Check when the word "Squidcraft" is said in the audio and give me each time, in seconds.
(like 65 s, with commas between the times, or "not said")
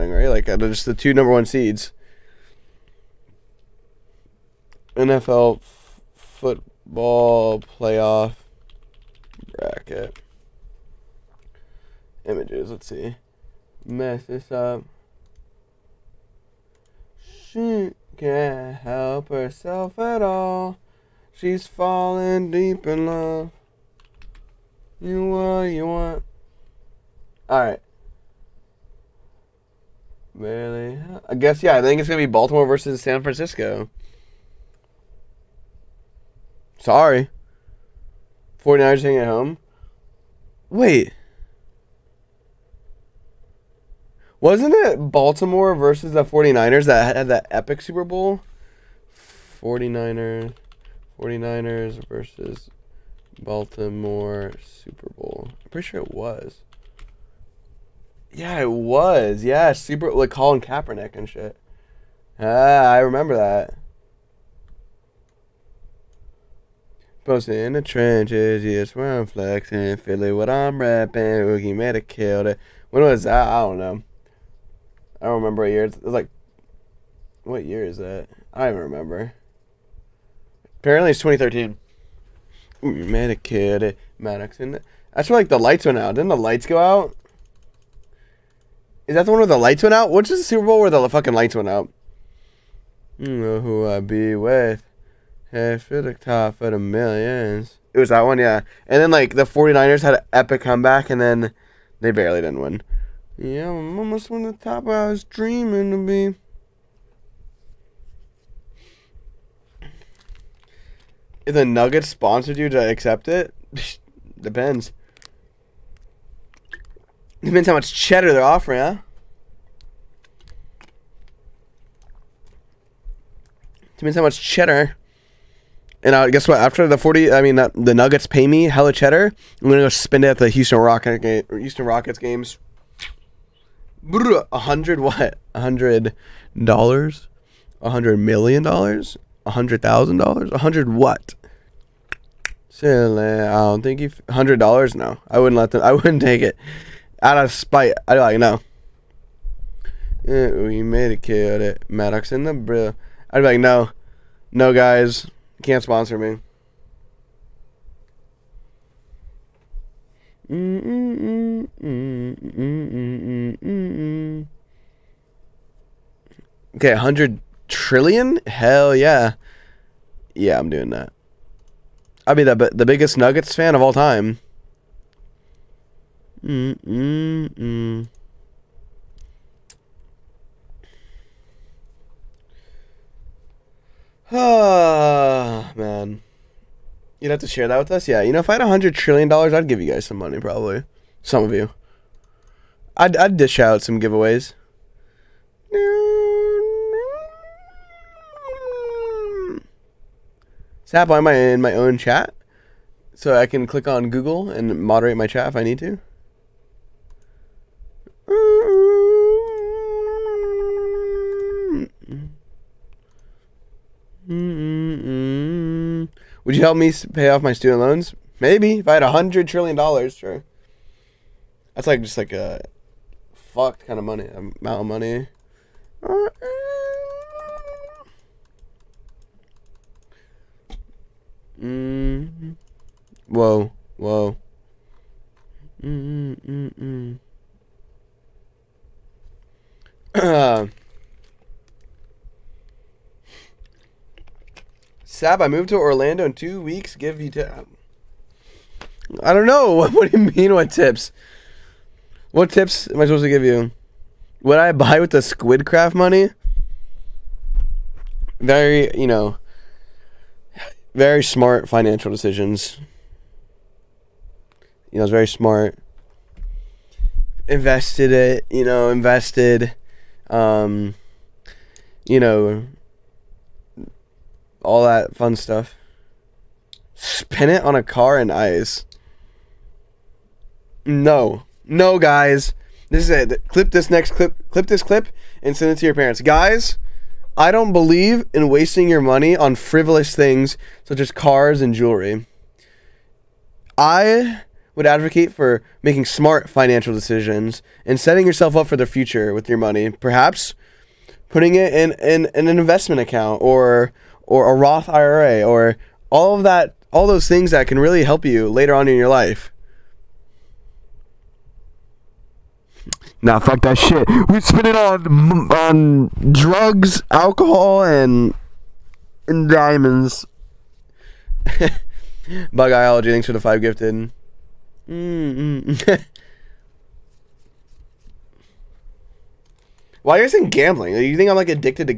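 255 s.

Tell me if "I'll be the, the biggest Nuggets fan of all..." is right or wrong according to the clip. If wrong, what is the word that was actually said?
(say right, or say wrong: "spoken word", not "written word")
right.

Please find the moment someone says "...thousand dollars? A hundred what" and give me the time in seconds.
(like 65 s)
139 s.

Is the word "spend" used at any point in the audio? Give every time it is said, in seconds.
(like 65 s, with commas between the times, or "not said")
129 s, 314 s.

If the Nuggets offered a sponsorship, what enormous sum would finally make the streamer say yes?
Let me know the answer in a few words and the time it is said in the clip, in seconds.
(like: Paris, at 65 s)
100 trillion, at 166 s.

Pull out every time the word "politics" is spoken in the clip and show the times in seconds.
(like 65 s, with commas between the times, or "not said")
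not said.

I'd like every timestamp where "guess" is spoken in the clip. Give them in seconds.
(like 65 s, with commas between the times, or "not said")
31 s, 126 s.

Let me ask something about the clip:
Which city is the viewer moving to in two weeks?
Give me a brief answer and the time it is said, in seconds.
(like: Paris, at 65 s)
Orlando, at 245 s.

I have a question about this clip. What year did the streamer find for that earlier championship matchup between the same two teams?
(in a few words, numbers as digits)
2013.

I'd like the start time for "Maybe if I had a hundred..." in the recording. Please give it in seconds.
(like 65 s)
218 s.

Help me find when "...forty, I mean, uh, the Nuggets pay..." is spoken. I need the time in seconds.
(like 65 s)
126 s.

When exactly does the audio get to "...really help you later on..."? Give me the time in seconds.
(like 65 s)
307 s.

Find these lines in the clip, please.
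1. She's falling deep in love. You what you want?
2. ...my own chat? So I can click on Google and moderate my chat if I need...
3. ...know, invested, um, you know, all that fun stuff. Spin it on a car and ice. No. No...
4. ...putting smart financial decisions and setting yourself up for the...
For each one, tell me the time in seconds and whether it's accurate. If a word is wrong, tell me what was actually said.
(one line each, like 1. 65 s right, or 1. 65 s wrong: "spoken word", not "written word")
1. 21 s right
2. 201 s right
3. 268 s right
4. 295 s wrong: "making", not "putting".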